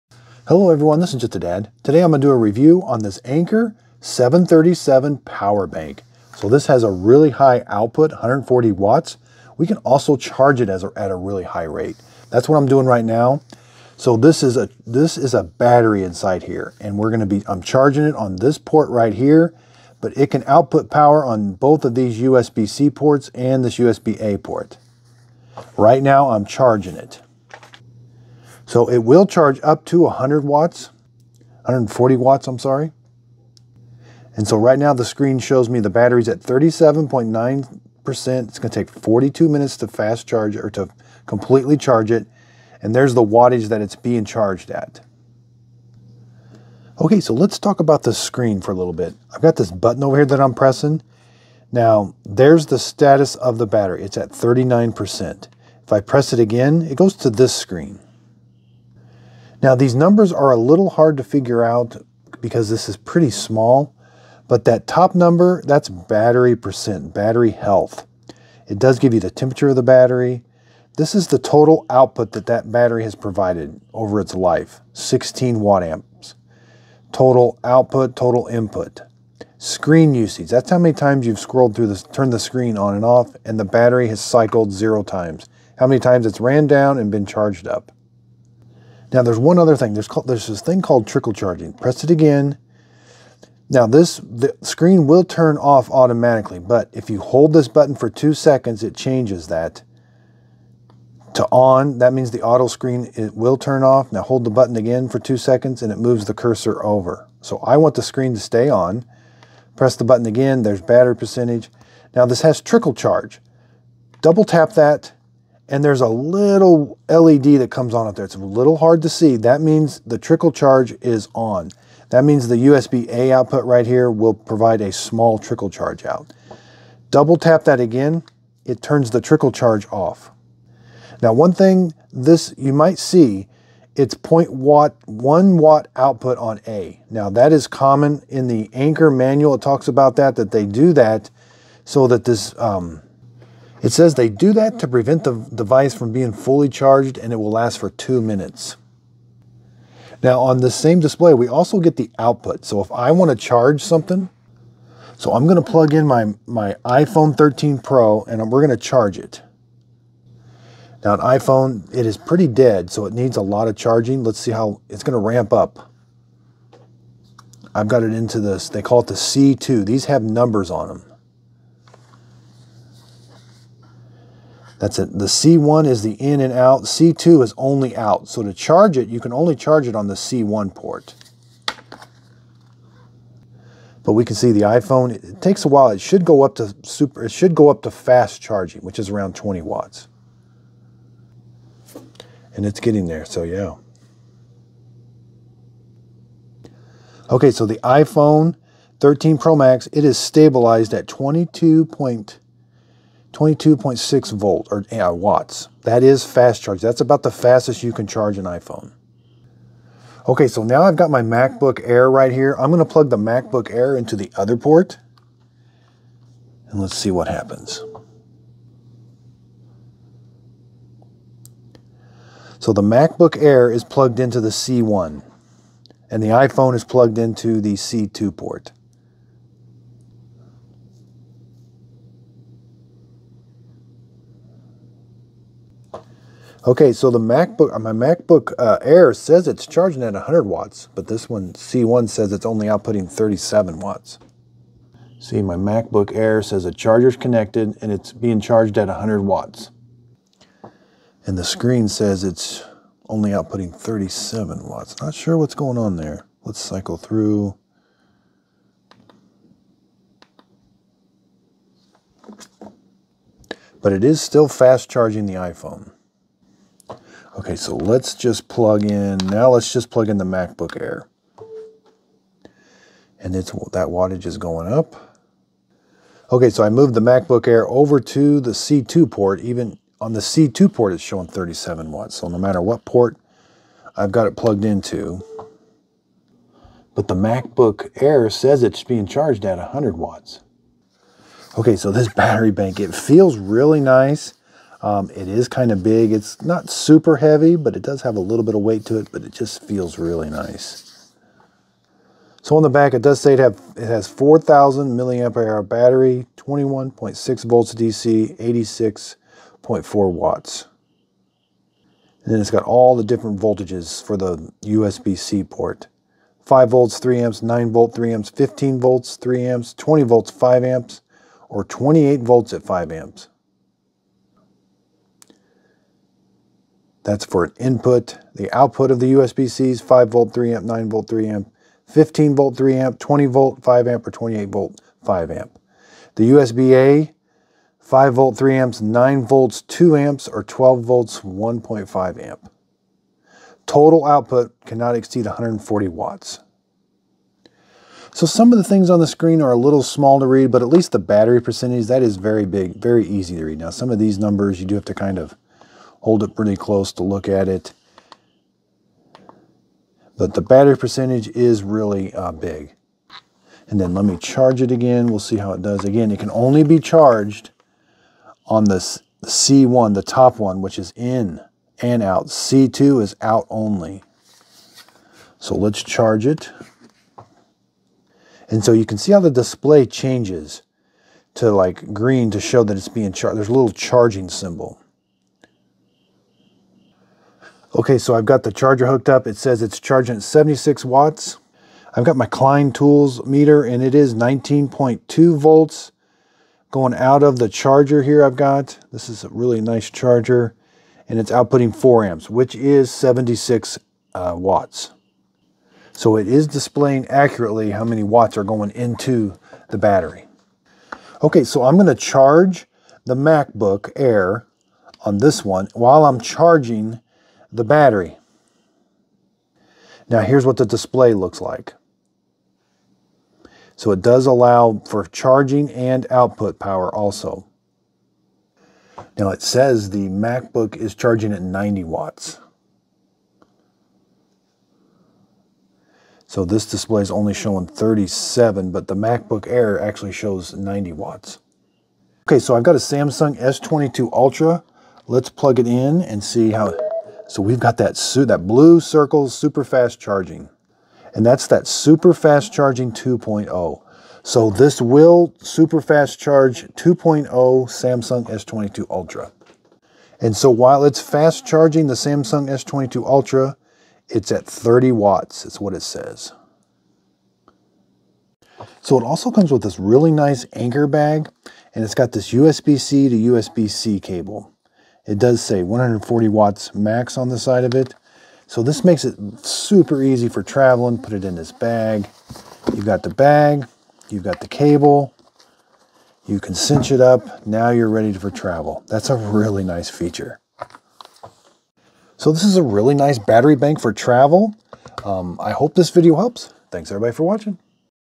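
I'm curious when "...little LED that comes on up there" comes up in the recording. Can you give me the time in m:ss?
1:56.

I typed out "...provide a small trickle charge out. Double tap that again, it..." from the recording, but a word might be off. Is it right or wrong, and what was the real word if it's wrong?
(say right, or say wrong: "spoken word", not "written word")
right.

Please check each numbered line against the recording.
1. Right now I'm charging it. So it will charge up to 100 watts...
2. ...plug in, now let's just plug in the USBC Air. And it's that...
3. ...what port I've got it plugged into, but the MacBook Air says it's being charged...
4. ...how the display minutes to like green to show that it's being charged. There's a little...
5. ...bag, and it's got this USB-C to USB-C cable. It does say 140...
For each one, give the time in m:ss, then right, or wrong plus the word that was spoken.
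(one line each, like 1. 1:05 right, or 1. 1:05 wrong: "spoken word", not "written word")
1. 0:25 right
2. 4:28 wrong: "MacBook", not "USBC"
3. 4:42 right
4. 6:19 wrong: "changes", not "minutes"
5. 7:50 right.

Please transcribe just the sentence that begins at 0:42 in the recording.
And there's the wattage that it's being charged at.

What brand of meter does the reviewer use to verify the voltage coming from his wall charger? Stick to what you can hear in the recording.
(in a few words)
Klein Tools.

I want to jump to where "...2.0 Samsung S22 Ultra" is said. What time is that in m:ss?
7:36.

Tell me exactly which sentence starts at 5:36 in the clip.
The USB-A, 5 volt, 3 amps, 9 volts, 2 amps, or 12 volts, 1.5 amp.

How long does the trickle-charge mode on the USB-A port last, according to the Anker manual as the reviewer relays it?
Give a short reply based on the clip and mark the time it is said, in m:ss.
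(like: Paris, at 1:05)
2 minutes, at 2:27.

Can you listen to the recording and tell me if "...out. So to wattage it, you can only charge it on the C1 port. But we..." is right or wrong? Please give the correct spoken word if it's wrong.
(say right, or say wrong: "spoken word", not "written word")
wrong: "charge", not "wattage".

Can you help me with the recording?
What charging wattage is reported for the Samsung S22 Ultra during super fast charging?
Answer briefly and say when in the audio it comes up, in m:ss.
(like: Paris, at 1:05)
30 watts, at 7:44.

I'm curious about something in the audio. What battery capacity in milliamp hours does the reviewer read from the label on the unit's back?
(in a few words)
4,000 mAh.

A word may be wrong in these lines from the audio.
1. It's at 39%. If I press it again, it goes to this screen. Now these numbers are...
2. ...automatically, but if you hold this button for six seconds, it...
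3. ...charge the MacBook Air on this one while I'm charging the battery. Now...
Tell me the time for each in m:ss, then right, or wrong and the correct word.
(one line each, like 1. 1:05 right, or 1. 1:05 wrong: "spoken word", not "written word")
1. 0:54 right
2. 1:35 wrong: "two", not "six"
3. 6:51 right.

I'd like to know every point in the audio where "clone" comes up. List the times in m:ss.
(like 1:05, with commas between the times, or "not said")
not said.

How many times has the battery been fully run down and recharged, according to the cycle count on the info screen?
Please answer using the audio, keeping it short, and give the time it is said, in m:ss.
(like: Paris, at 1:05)
0, at 1:24.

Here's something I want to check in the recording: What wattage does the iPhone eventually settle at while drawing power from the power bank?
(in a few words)
22.6 watts.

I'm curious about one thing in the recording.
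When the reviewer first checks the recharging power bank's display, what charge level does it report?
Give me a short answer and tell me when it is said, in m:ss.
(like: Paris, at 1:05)
37.9%, at 0:36.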